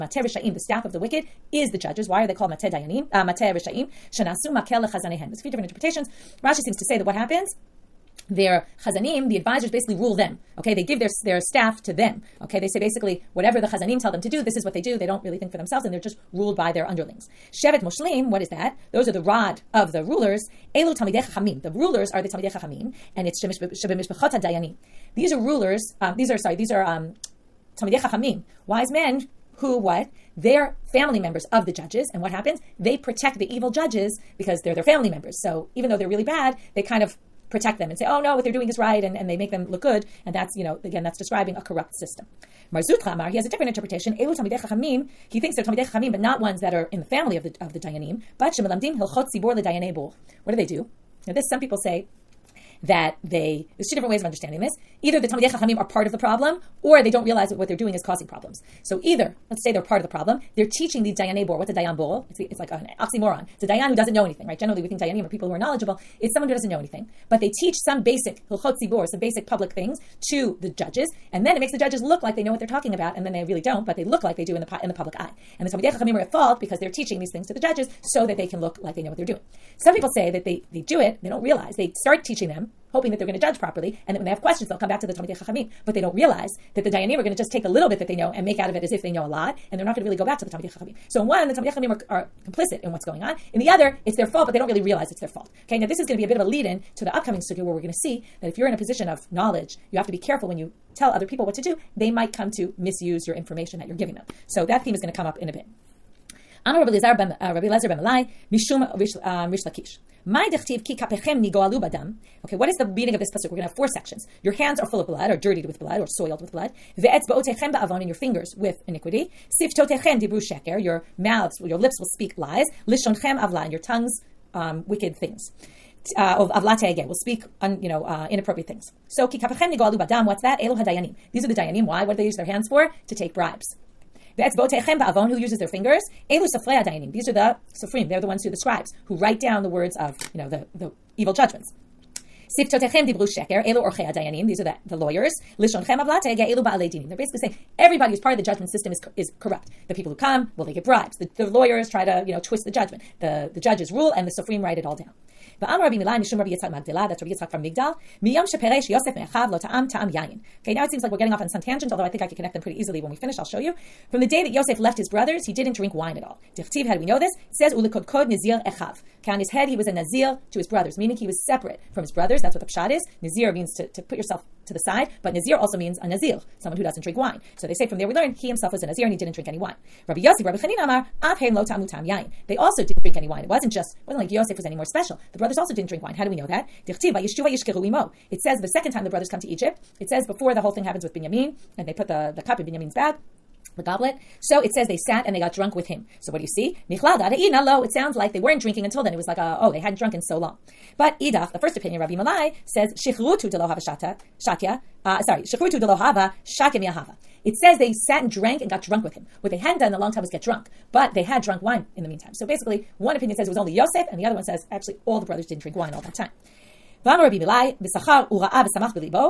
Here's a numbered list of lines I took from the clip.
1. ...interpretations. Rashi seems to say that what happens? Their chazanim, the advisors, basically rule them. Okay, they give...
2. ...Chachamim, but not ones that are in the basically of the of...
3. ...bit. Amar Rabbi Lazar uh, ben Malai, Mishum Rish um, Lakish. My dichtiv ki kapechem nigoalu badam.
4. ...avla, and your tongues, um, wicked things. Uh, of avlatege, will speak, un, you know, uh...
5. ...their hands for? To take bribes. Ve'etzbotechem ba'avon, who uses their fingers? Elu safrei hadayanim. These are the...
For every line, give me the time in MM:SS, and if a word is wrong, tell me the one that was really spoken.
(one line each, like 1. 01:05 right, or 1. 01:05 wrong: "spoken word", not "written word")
1. 00:05 right
2. 00:45 wrong: "family", not "basically"
3. 01:45 right
4. 02:03 right
5. 02:12 right.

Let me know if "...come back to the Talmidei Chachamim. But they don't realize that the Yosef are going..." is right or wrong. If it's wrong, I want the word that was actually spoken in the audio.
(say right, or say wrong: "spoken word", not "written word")
wrong: "Dayanim", not "Yosef".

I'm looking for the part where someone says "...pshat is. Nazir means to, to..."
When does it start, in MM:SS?
02:52.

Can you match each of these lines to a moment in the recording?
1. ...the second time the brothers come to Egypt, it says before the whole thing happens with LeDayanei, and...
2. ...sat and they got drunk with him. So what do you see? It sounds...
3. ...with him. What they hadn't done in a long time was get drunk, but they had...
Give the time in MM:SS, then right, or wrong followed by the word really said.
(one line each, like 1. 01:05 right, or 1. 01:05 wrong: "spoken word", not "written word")
1. 03:08 wrong: "Binyamin", not "LeDayanei"
2. 03:15 right
3. 03:29 right.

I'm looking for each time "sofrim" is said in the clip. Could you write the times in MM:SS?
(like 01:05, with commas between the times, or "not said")
02:17, 02:34.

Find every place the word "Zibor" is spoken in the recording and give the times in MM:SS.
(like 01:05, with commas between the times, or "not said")
00:49, 01:08.